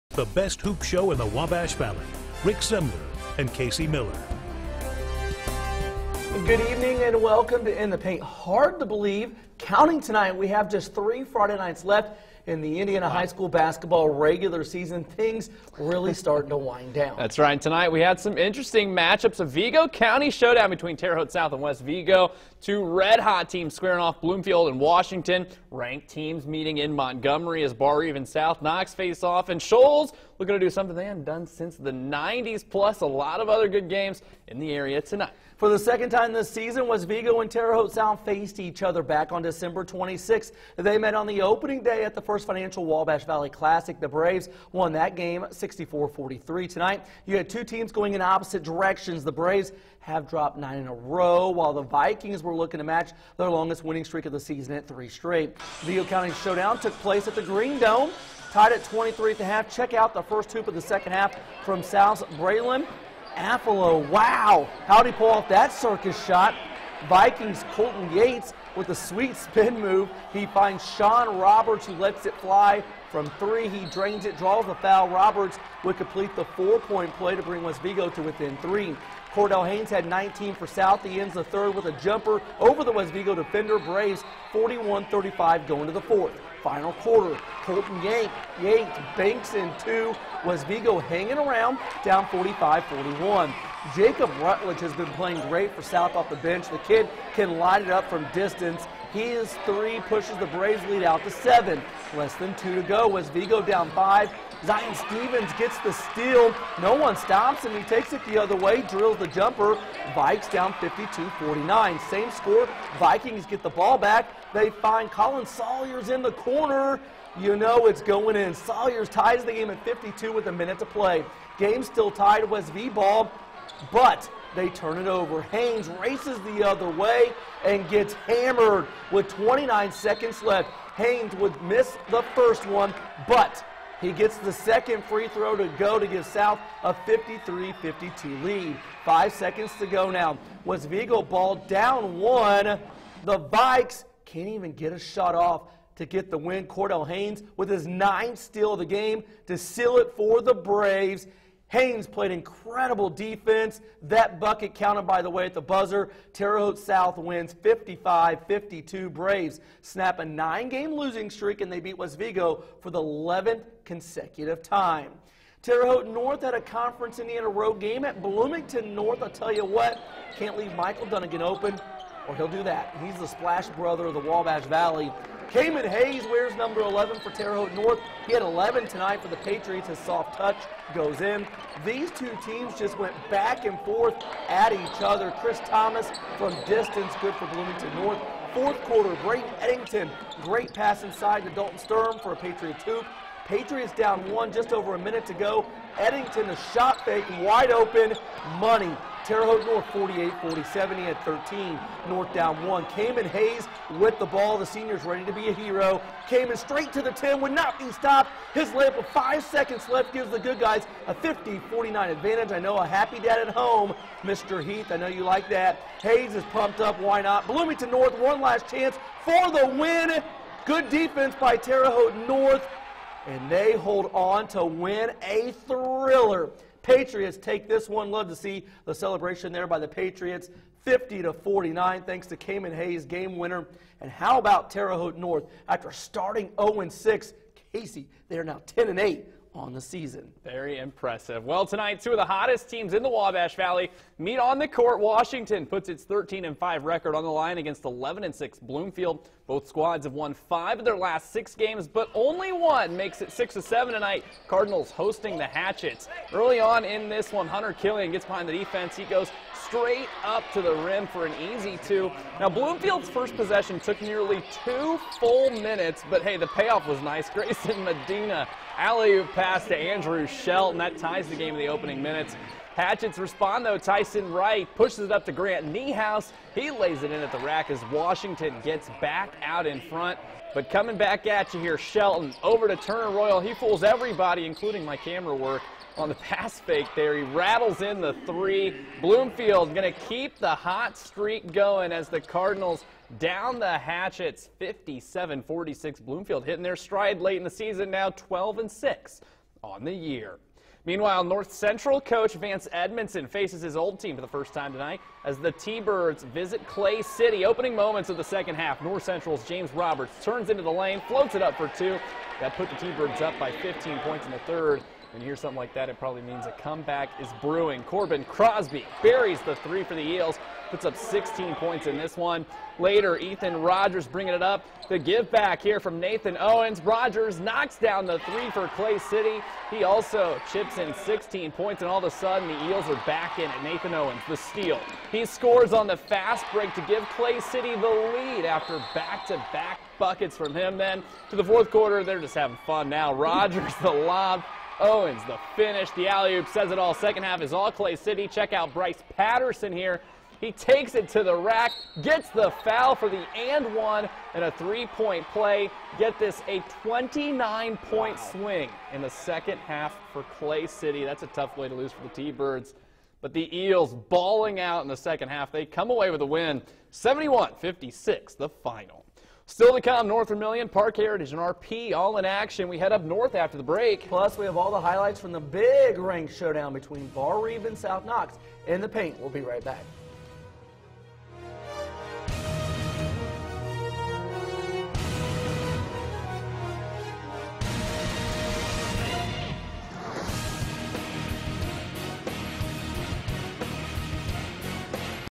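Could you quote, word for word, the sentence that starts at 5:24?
The give back here from Nathan Owens.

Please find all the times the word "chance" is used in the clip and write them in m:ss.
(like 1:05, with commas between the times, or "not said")
3:38.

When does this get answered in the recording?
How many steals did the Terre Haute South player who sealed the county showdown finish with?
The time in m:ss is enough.
2:27.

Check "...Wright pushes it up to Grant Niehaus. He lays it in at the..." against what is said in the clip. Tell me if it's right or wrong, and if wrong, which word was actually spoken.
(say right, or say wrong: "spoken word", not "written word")
right.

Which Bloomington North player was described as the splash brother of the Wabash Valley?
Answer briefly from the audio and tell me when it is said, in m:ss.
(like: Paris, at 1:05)
Michael Dunnigan, at 2:50.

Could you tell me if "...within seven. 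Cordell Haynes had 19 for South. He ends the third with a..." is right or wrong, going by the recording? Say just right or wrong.
wrong.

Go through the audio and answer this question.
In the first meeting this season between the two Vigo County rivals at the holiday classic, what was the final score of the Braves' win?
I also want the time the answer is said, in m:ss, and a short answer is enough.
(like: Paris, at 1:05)
64-43, at 0:45.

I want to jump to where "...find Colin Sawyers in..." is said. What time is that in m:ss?
1:54.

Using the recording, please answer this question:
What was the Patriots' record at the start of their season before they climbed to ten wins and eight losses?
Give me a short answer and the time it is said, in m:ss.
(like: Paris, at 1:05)
0-6, at 3:56.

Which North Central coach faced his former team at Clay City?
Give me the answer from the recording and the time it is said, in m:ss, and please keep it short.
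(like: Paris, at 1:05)
Vance Edmondson, at 5:02.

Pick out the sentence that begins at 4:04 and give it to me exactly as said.
Washington puts its 13 and 5 record on the line against 11 and 6 Bloomfield.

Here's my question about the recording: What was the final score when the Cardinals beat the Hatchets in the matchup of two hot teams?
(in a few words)
57-46.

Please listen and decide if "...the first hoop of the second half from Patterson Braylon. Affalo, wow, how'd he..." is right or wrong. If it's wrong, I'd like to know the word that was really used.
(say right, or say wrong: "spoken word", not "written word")
wrong: "South", not "Patterson".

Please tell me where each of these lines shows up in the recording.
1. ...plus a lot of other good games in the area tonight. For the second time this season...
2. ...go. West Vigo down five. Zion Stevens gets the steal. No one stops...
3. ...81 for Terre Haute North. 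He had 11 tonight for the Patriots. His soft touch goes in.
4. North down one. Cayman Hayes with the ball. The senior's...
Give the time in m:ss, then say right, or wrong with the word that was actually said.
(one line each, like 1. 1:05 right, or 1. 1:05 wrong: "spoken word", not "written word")
1. 0:32 right
2. 1:42 right
3. 2:56 wrong: "11", not "81"
4. 3:22 right.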